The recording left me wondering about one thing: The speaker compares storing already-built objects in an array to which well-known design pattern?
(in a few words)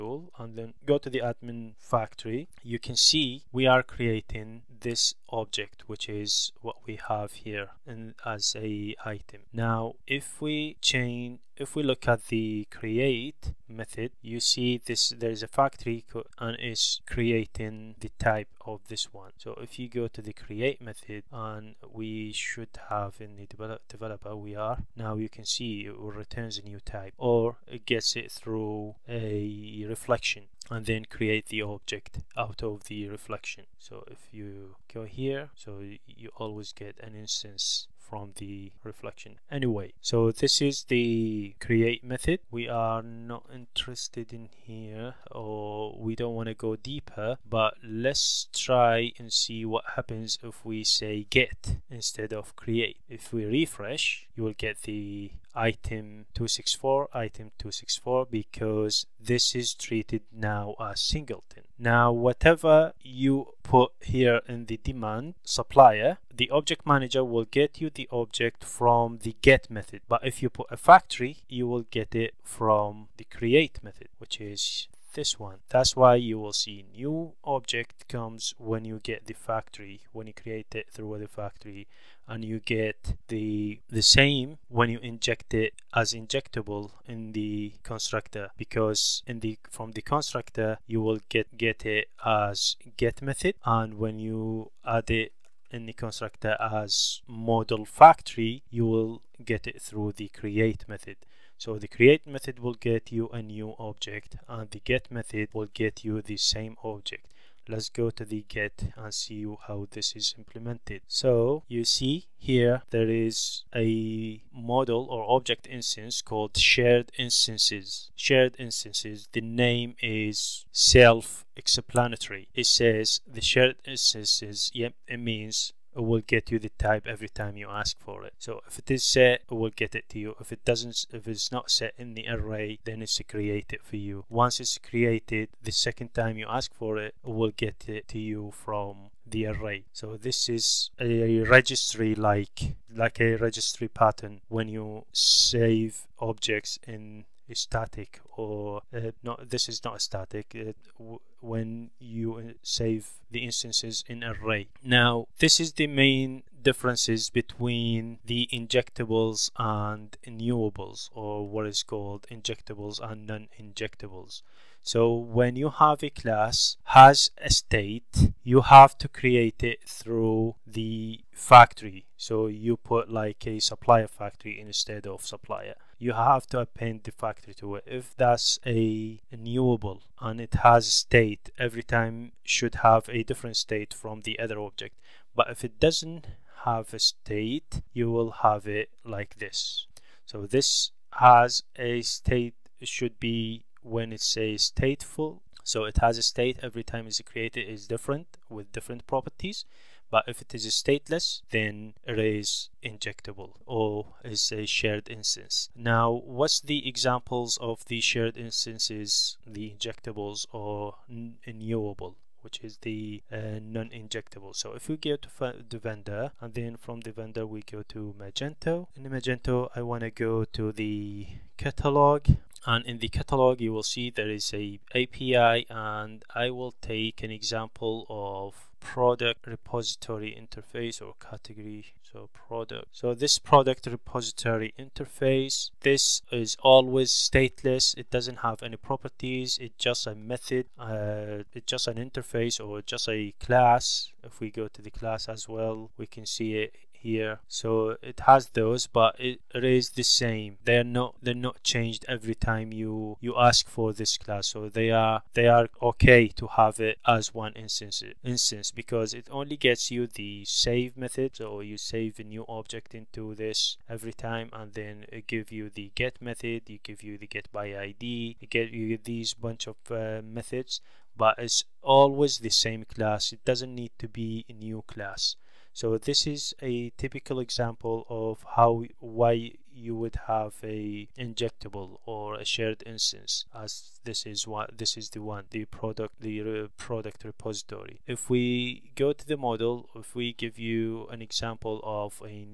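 registry pattern.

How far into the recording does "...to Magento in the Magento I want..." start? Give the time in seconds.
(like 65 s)
217 s.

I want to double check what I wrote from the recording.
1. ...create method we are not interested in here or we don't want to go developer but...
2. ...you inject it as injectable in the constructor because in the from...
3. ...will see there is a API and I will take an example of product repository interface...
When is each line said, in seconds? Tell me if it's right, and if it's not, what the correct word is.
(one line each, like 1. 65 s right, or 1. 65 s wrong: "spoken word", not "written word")
1. 41 s wrong: "deeper", not "developer"
2. 84 s right
3. 223 s right.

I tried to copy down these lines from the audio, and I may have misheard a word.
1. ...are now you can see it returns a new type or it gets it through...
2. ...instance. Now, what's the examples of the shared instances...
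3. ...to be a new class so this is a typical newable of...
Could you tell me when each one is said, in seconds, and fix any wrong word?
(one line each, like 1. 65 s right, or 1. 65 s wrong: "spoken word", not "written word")
1. 24 s right
2. 205 s right
3. 273 s wrong: "example", not "newable".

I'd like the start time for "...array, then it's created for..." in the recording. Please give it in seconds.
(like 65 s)
132 s.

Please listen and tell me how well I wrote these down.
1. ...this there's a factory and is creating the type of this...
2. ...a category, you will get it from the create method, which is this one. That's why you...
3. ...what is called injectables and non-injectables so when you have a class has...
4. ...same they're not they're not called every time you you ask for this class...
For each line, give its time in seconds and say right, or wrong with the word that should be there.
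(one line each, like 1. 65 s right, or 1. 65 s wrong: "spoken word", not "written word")
1. 14 s right
2. 70 s wrong: "factory", not "category"
3. 161 s right
4. 250 s wrong: "changed", not "called".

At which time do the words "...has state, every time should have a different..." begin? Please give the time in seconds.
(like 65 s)
180 s.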